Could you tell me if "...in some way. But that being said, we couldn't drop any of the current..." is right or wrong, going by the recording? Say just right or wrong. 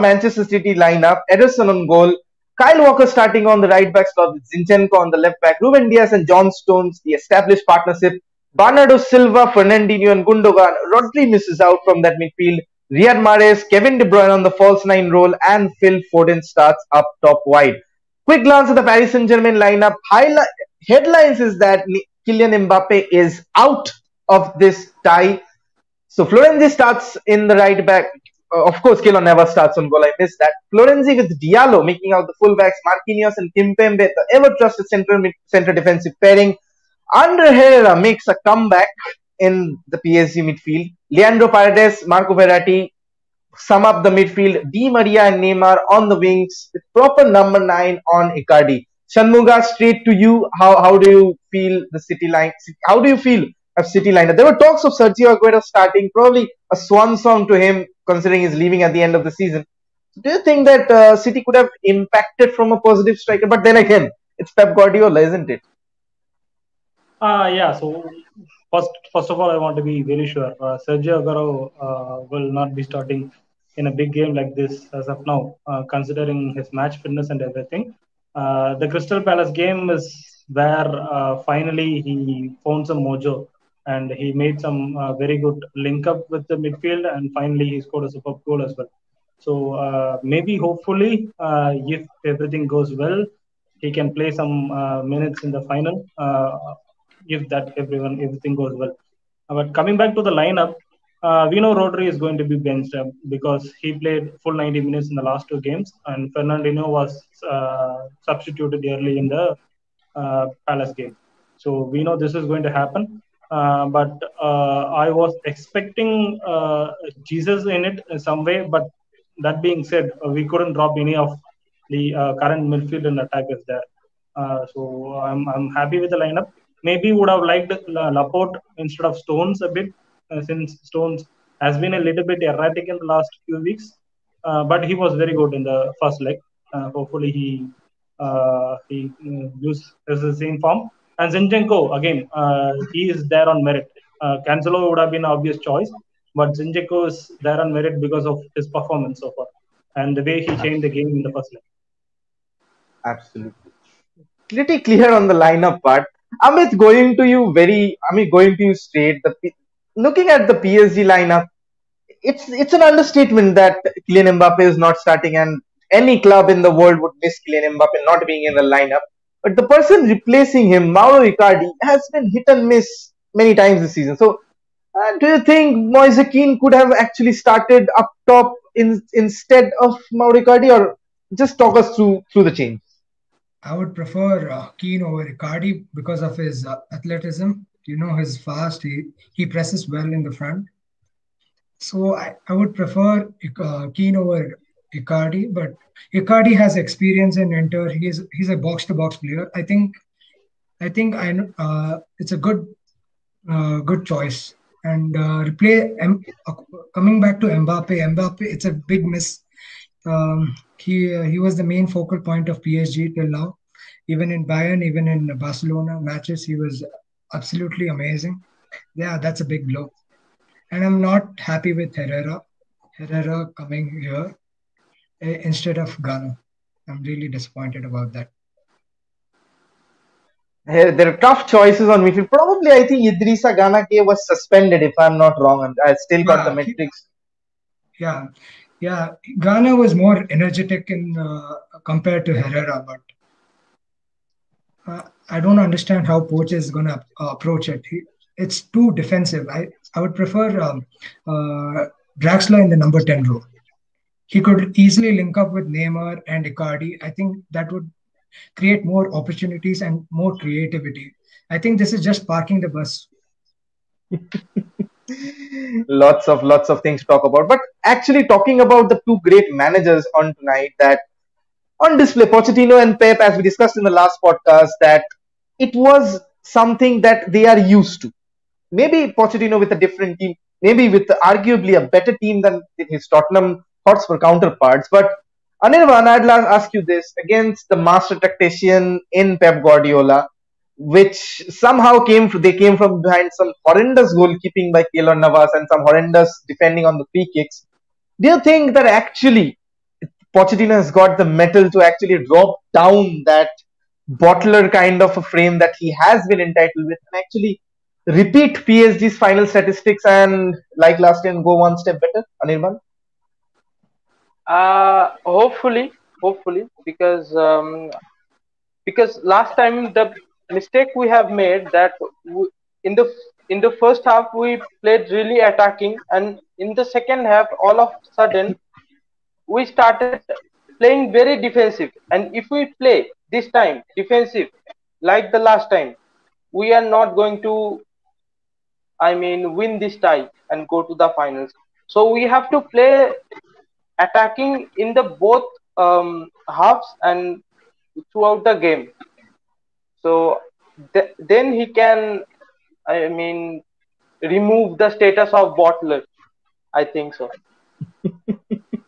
right.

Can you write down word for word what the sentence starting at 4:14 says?
He could easily link up with Neymar and Icardi.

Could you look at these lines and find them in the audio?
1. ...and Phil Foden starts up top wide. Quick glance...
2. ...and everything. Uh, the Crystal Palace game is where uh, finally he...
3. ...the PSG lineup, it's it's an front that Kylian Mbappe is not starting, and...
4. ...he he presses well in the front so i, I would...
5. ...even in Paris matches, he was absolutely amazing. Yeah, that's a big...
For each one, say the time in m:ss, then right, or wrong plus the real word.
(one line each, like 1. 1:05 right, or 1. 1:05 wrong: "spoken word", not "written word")
1. 0:15 right
2. 1:17 right
3. 2:40 wrong: "understatement", not "front"
4. 3:08 right
5. 3:34 wrong: "Barcelona", not "Paris".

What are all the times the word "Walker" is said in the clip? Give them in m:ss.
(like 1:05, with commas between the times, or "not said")
0:02.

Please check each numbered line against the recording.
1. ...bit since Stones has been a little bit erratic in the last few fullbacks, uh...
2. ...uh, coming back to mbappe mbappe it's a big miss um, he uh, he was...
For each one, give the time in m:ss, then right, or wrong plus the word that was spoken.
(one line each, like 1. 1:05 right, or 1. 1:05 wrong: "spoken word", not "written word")
1. 2:09 wrong: "weeks", not "fullbacks"
2. 3:26 right.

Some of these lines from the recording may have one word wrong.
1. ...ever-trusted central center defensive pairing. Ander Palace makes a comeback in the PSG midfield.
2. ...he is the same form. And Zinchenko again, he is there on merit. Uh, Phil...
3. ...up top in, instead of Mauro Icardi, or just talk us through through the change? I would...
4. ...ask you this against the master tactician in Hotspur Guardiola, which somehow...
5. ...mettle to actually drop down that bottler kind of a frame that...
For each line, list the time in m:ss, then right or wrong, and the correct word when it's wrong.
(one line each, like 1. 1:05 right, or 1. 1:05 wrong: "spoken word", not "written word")
1. 0:34 wrong: "Herrera", not "Palace"
2. 2:18 wrong: "Cancelo", not "Phil"
3. 2:57 right
4. 4:46 wrong: "Pep", not "Hotspur"
5. 5:01 right.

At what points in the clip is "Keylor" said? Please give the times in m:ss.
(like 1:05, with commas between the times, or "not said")
0:29, 4:54.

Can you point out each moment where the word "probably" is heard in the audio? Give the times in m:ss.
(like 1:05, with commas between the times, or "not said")
0:56, 3:52.